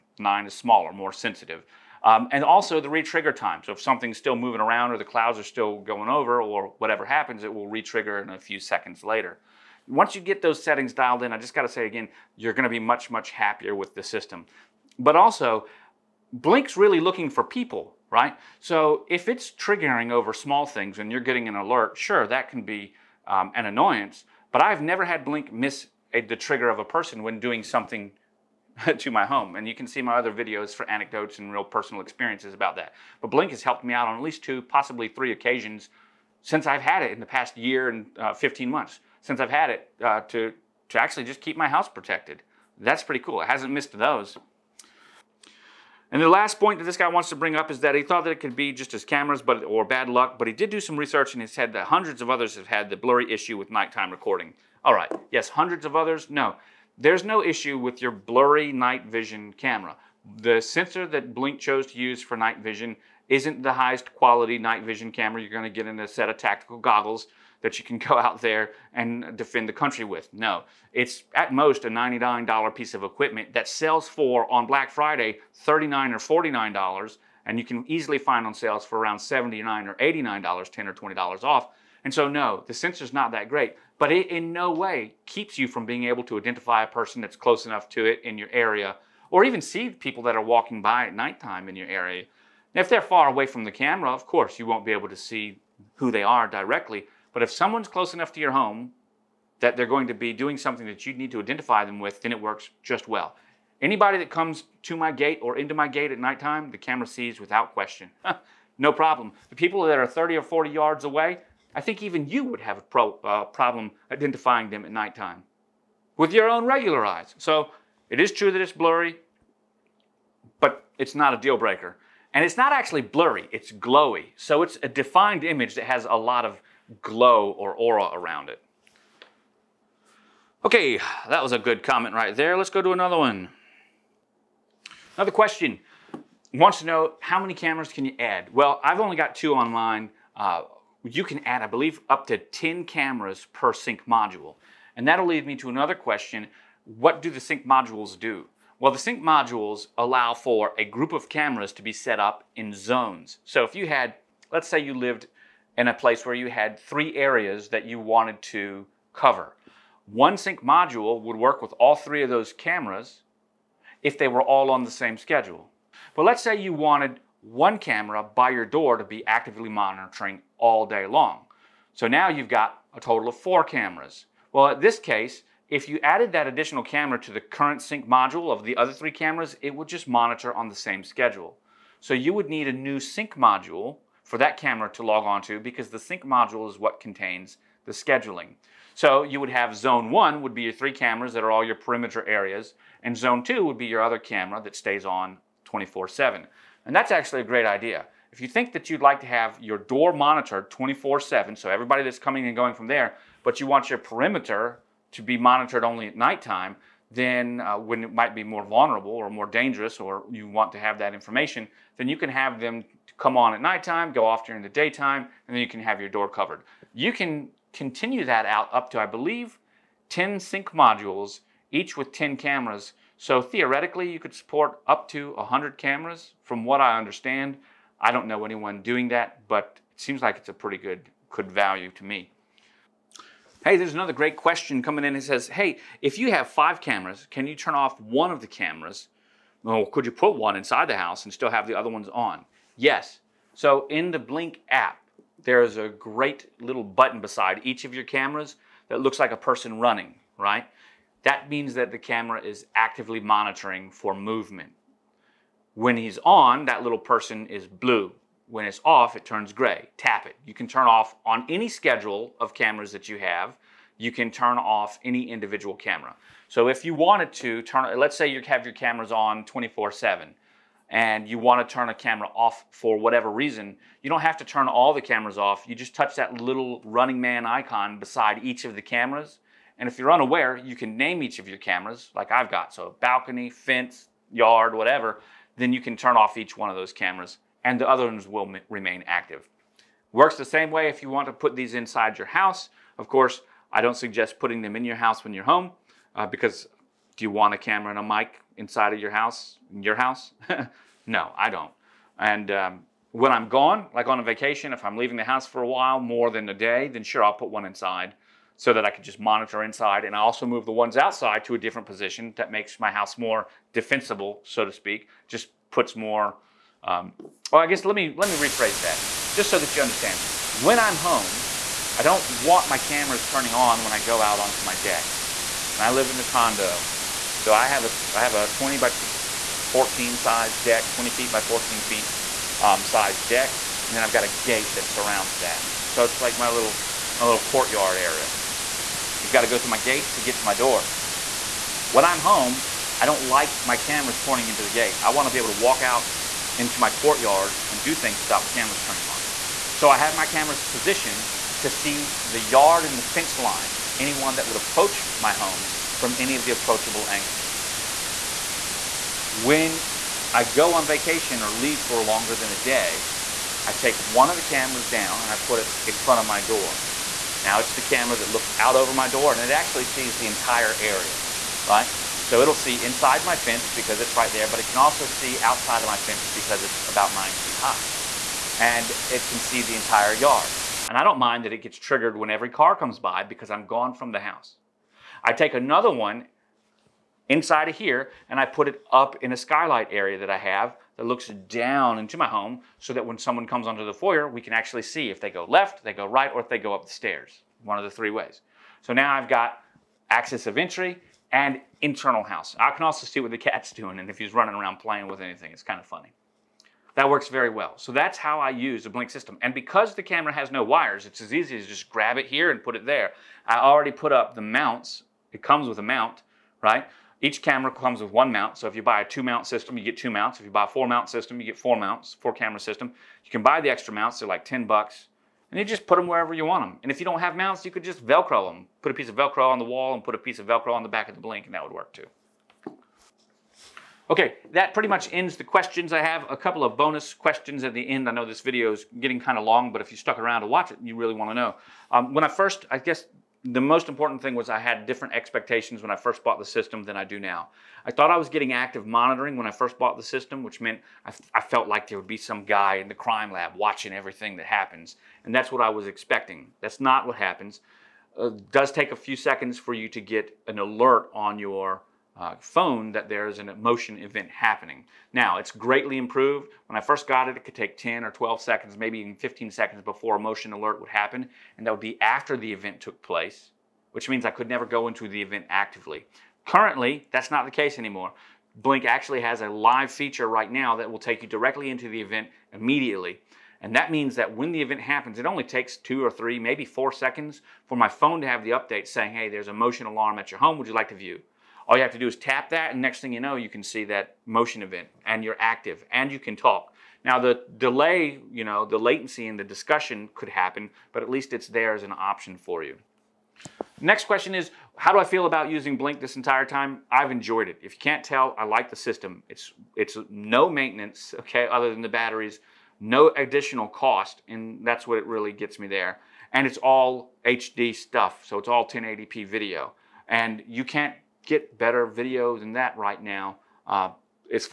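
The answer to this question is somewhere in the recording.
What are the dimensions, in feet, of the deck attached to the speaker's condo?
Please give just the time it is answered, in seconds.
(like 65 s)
328 s.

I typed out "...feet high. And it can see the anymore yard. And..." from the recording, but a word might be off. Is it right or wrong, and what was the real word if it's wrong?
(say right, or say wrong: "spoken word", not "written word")
wrong: "entire", not "anymore".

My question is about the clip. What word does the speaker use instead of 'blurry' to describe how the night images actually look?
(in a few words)
glowy.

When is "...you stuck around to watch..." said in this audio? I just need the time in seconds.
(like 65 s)
439 s.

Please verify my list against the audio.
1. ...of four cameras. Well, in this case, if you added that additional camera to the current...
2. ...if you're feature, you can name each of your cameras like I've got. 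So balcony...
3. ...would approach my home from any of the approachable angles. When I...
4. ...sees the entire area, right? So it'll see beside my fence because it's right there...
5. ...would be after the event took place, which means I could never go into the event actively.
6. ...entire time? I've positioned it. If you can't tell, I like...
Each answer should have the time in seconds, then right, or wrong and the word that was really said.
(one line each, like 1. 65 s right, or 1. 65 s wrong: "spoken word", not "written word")
1. 173 s right
2. 279 s wrong: "unaware", not "feature"
3. 354 s right
4. 369 s wrong: "inside", not "beside"
5. 471 s right
6. 506 s wrong: "enjoyed", not "positioned".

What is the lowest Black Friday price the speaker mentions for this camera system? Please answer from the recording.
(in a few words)
$39.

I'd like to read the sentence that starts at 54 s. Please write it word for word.
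All right, yes, hundreds of others?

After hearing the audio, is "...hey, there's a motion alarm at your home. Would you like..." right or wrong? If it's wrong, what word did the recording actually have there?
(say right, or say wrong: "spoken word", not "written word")
right.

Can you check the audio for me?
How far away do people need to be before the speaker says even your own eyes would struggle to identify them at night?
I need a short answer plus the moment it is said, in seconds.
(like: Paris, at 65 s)
30 or 40 yards, at 110 s.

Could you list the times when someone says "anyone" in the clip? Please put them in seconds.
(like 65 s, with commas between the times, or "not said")
228 s, 353 s.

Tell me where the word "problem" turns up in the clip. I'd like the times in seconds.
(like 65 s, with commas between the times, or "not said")
108 s, 113 s.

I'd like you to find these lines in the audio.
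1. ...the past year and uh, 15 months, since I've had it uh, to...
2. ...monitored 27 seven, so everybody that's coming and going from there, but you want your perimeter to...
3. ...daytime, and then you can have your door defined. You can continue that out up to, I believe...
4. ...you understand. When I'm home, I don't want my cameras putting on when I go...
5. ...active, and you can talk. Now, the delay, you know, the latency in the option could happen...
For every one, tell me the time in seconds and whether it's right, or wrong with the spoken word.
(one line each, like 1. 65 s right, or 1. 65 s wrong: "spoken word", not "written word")
1. 37 s right
2. 200 s wrong: "24", not "27"
3. 214 s wrong: "covered", not "defined"
4. 319 s wrong: "turning", not "putting"
5. 495 s wrong: "discussion", not "option".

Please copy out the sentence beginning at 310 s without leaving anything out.
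And I also move the ones outside to a different position that makes my house more defensible, so to speak.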